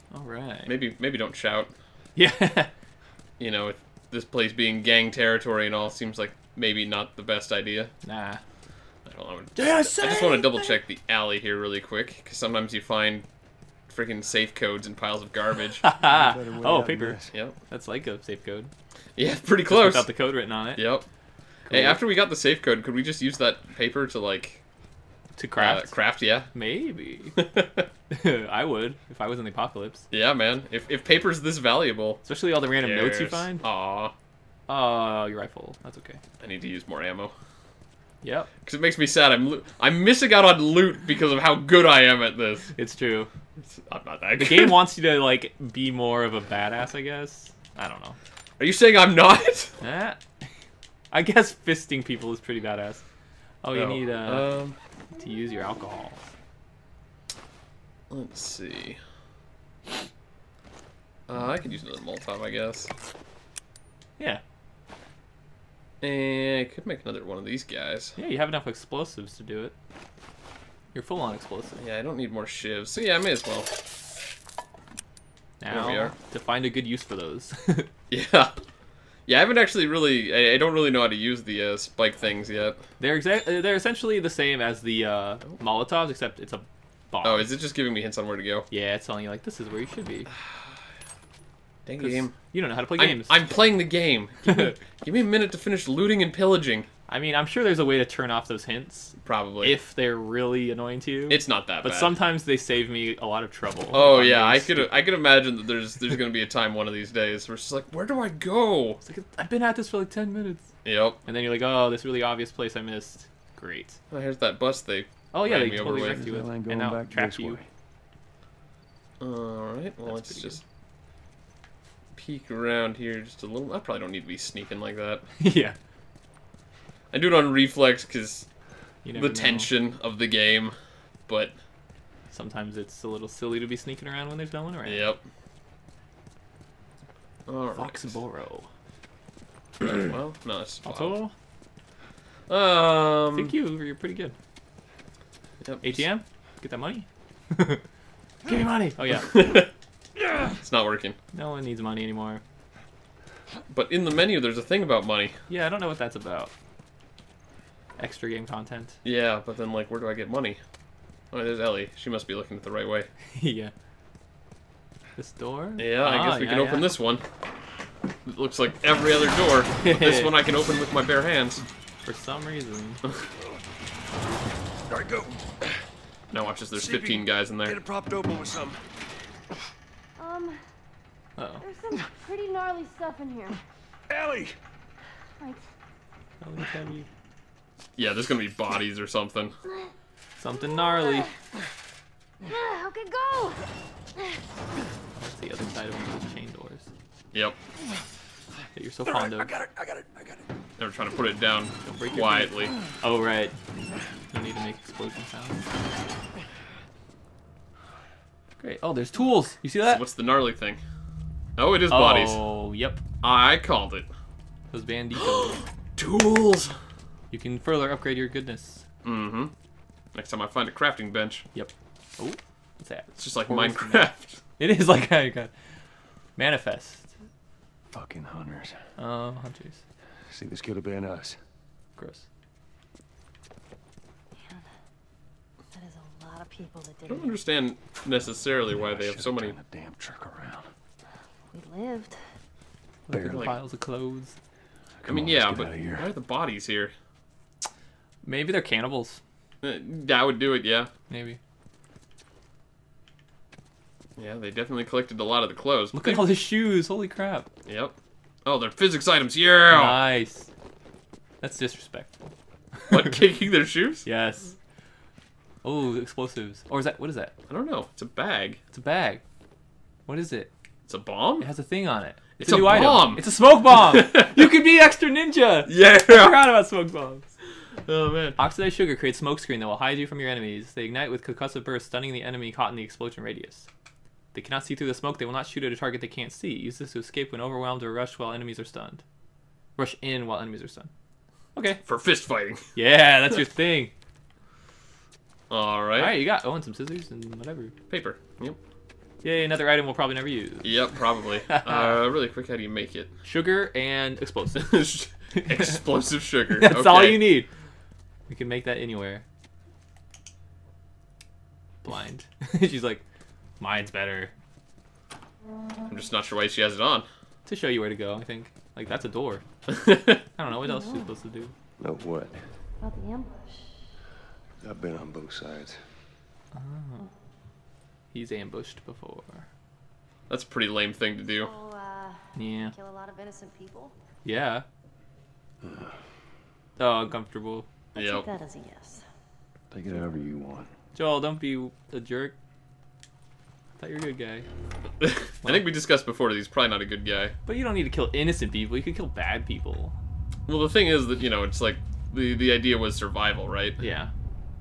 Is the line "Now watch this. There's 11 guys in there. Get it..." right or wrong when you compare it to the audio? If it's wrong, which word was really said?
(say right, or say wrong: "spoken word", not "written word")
wrong: "15", not "11".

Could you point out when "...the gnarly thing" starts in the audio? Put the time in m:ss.
3:30.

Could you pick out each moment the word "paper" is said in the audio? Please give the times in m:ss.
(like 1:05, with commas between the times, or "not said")
0:16, 0:23, 0:31, 4:57.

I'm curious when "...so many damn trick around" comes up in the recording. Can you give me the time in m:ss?
3:59.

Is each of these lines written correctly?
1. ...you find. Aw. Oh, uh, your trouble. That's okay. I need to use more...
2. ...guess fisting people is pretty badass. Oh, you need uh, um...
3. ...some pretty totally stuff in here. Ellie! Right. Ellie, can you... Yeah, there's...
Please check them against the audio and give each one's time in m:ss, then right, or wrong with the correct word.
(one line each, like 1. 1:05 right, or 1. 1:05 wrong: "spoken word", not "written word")
1. 0:33 wrong: "rifle", not "trouble"
2. 0:51 right
3. 3:01 wrong: "gnarly", not "totally".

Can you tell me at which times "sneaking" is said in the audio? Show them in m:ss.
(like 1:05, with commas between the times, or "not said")
2:04, 2:13.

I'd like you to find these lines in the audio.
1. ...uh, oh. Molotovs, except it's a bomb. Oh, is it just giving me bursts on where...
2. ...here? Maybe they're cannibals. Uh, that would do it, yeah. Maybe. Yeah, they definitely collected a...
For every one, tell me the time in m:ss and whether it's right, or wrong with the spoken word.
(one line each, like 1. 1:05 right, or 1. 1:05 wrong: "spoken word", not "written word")
1. 1:25 wrong: "hints", not "bursts"
2. 4:06 right.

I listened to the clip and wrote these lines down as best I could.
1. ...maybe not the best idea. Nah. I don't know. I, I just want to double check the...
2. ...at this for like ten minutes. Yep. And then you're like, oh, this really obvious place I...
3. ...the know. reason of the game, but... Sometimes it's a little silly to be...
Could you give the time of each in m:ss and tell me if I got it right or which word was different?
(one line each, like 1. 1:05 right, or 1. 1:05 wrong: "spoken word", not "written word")
1. 0:06 right
2. 1:49 right
3. 2:09 wrong: "tension", not "reason".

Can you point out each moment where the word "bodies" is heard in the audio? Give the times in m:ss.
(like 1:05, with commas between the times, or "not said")
3:08, 3:31, 4:06.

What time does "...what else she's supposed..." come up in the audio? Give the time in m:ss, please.
5:20.